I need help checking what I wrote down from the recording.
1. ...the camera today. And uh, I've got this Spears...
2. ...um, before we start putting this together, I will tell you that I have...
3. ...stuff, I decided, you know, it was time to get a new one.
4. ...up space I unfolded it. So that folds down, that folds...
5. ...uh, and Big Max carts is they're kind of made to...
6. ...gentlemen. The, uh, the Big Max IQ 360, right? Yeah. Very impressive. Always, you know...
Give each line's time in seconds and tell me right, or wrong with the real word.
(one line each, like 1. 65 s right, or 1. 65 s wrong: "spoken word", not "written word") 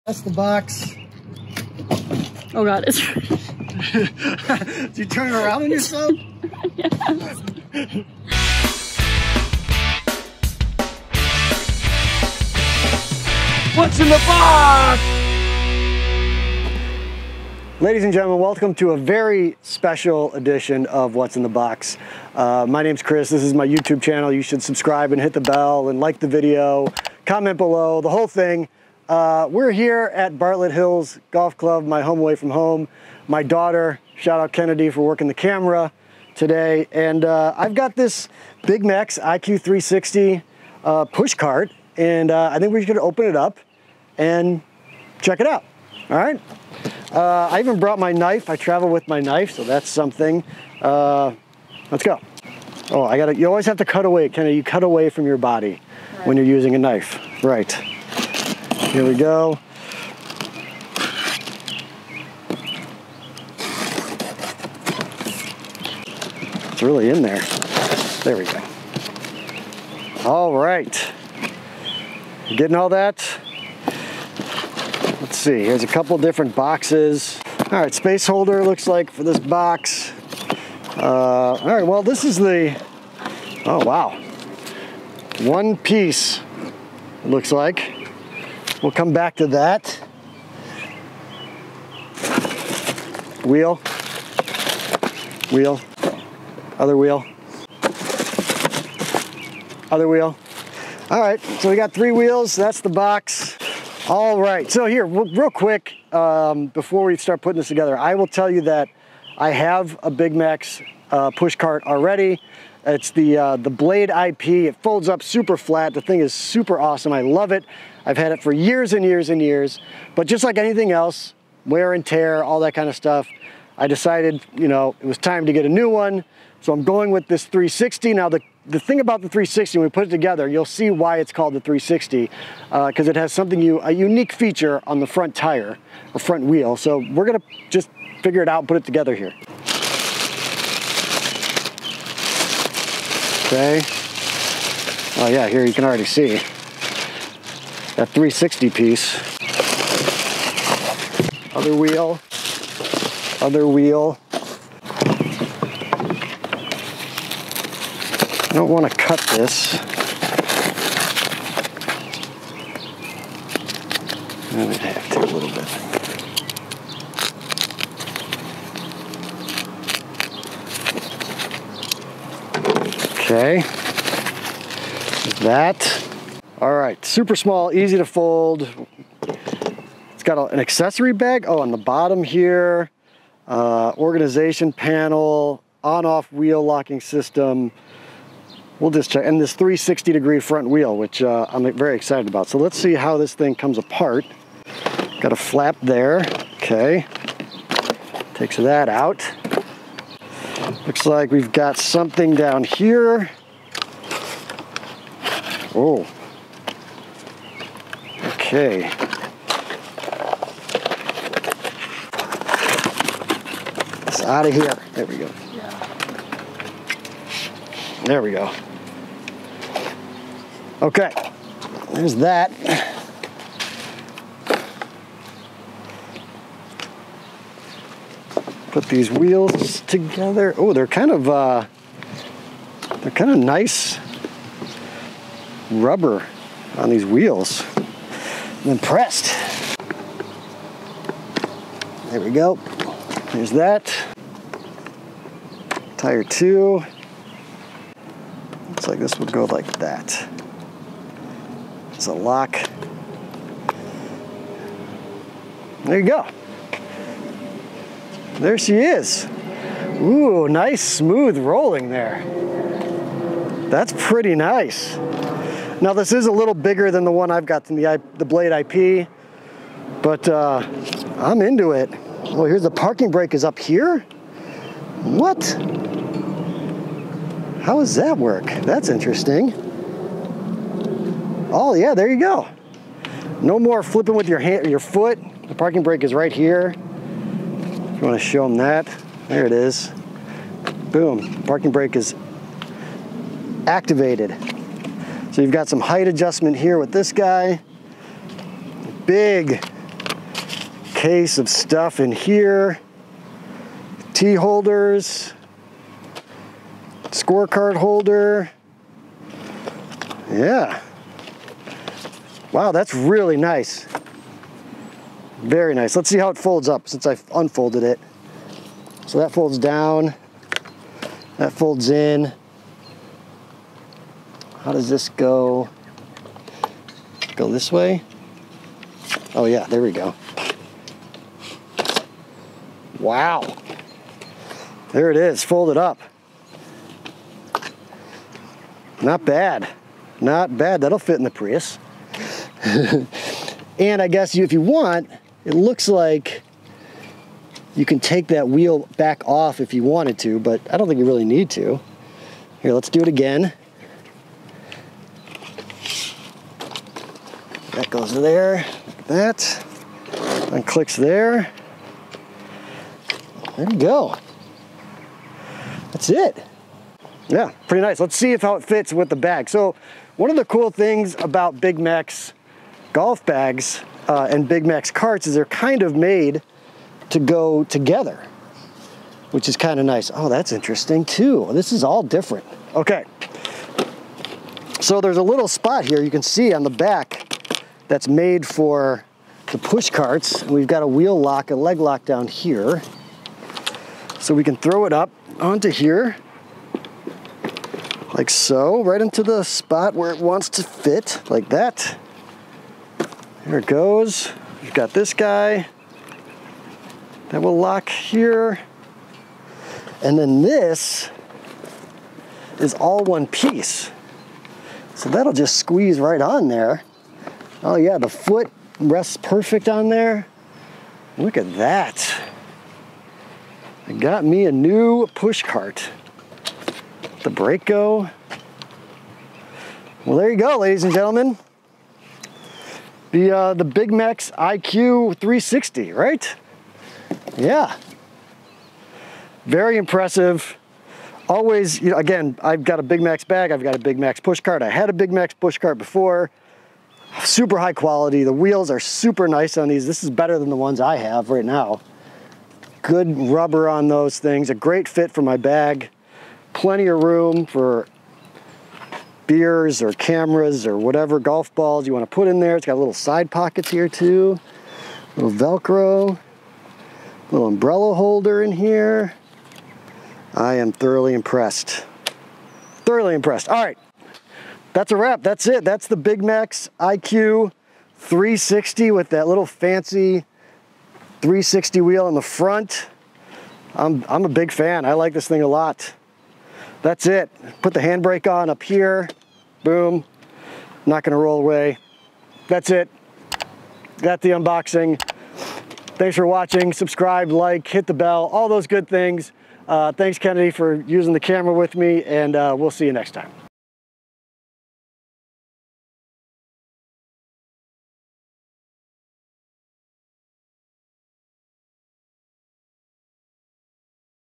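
1. 35 s wrong: "Big", not "Spears"
2. 106 s right
3. 122 s right
4. 316 s wrong: "since", not "space"
5. 374 s right
6. 430 s right.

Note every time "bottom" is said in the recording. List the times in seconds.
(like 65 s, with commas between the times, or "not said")
181 s.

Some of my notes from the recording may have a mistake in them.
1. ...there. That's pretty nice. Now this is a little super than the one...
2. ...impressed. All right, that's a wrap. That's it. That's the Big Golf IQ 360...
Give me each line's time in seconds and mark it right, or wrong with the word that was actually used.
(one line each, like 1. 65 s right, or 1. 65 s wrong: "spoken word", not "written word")
1. 261 s wrong: "bigger", not "super"
2. 473 s wrong: "Max", not "Golf".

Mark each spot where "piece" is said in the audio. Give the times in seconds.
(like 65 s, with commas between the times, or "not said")
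85 s, 148 s, 413 s.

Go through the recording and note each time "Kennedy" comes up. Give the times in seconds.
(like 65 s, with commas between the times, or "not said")
34 s, 54 s, 500 s.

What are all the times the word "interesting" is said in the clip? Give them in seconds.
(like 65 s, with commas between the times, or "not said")
278 s, 380 s.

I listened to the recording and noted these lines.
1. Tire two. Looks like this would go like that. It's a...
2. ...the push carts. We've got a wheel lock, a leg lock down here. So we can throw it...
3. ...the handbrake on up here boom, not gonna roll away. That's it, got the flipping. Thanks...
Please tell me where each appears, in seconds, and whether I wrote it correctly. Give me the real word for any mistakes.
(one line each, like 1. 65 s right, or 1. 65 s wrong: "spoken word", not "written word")
1. 245 s right
2. 389 s right
3. 487 s wrong: "unboxing", not "flipping".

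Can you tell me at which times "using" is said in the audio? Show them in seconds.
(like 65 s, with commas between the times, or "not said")
56 s, 500 s.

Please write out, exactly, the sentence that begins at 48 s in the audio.
I travel with my knife, so that's something.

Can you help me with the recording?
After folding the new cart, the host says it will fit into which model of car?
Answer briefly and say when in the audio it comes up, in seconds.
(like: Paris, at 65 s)
Prius, at 341 s.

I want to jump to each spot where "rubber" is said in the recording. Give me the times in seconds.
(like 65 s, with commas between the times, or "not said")
235 s, 453 s.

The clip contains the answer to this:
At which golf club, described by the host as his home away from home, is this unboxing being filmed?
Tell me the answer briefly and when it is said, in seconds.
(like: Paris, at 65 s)
Bartlett Hills Golf Club, at 30 s.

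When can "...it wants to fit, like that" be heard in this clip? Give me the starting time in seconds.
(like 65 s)
400 s.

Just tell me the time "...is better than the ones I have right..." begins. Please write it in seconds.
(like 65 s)
450 s.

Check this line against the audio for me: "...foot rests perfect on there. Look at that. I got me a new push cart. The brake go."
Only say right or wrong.
right.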